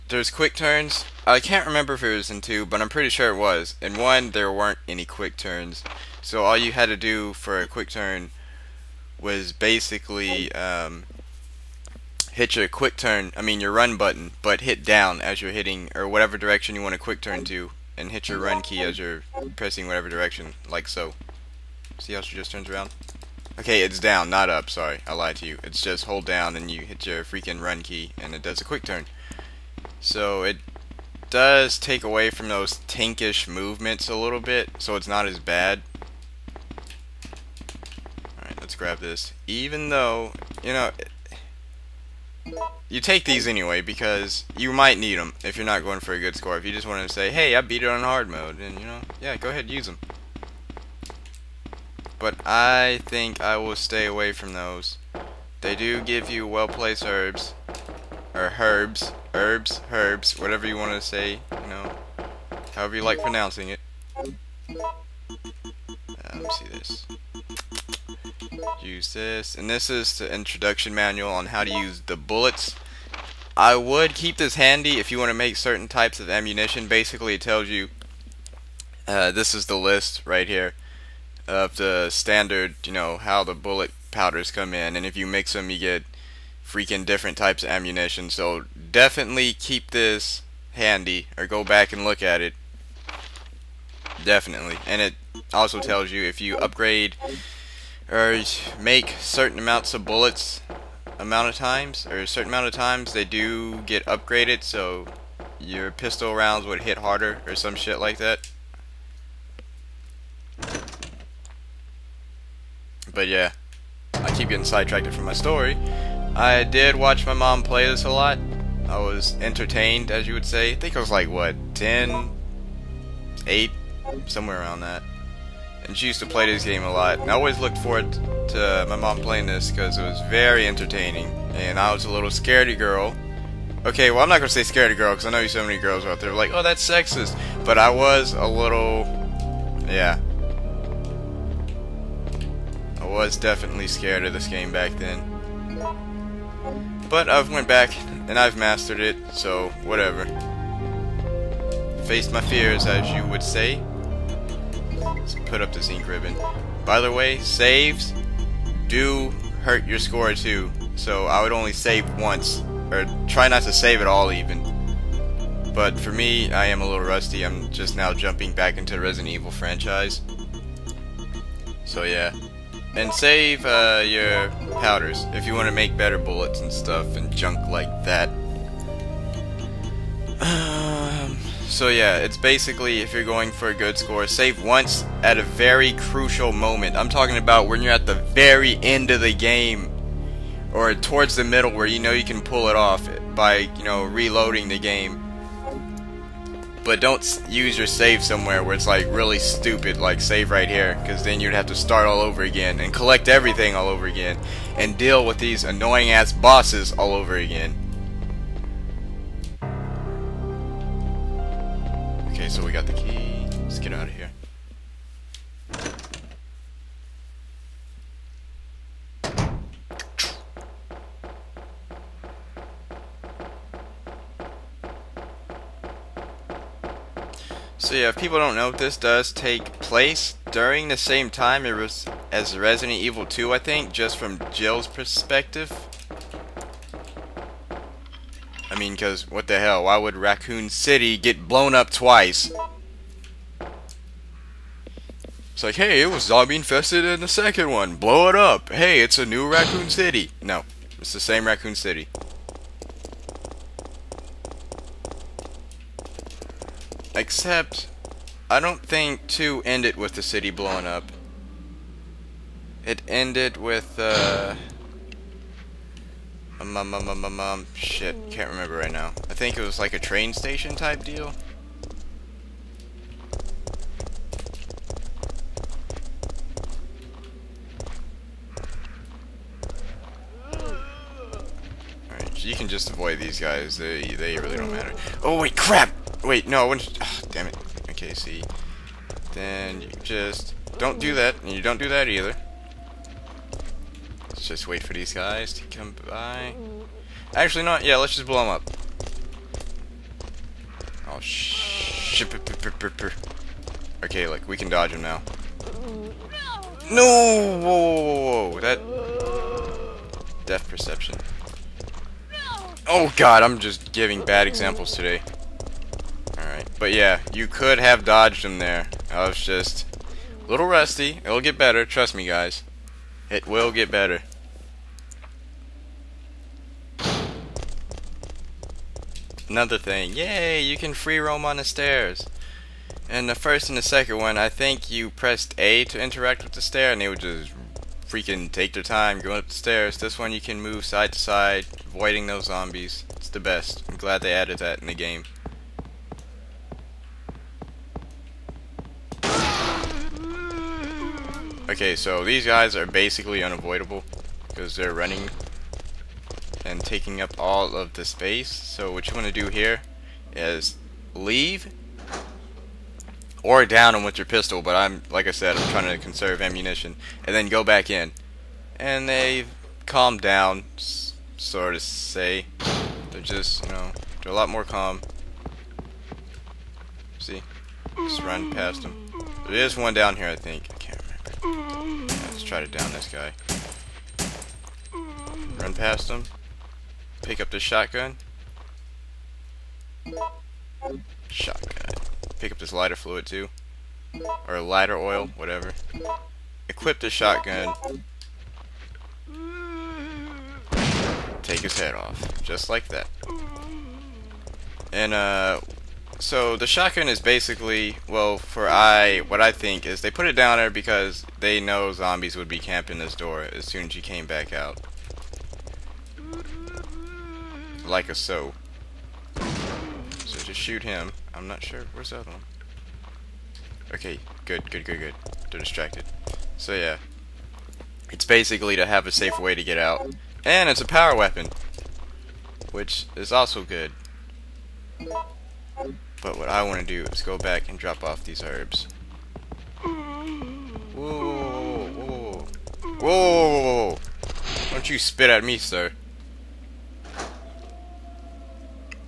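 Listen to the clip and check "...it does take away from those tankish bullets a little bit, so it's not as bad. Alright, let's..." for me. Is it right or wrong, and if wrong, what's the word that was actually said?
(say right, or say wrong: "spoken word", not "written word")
wrong: "movements", not "bullets".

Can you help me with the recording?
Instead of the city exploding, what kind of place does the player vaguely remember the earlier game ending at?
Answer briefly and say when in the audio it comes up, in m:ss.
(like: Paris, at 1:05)
a train station, at 4:29.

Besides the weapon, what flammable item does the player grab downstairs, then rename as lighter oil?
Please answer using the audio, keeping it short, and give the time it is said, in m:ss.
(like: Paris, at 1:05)
lighter fluid, at 6:32.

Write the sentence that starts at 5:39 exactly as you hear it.
This one you can move side to side, avoiding those zombies.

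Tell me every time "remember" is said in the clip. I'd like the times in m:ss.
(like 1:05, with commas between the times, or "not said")
0:01, 4:28.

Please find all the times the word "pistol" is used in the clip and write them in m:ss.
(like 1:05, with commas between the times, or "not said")
1:45, 6:04.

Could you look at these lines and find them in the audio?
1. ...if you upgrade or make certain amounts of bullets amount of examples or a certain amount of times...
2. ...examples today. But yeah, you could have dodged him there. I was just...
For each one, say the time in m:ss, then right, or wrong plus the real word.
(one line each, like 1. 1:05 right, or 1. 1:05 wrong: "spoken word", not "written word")
1. 1:36 wrong: "times", not "examples"
2. 5:14 right.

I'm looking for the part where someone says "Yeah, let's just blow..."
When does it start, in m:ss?
4:57.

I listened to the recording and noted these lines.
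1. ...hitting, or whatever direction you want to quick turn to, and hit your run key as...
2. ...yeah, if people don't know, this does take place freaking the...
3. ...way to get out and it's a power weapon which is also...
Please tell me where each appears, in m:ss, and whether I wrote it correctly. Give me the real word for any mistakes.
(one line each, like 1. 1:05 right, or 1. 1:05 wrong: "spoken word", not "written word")
1. 0:15 right
2. 3:47 wrong: "during", not "freaking"
3. 7:09 right.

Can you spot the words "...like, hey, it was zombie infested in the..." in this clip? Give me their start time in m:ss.
4:05.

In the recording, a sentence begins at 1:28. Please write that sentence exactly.
So definitely keep this handy or go back and look at it.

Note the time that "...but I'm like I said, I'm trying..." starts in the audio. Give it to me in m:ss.
6:04.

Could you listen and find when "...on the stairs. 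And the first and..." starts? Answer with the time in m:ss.
5:31.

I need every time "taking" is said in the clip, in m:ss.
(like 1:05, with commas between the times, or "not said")
5:56.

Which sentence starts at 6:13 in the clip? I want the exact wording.
They're just, you know, they're a lot more calm.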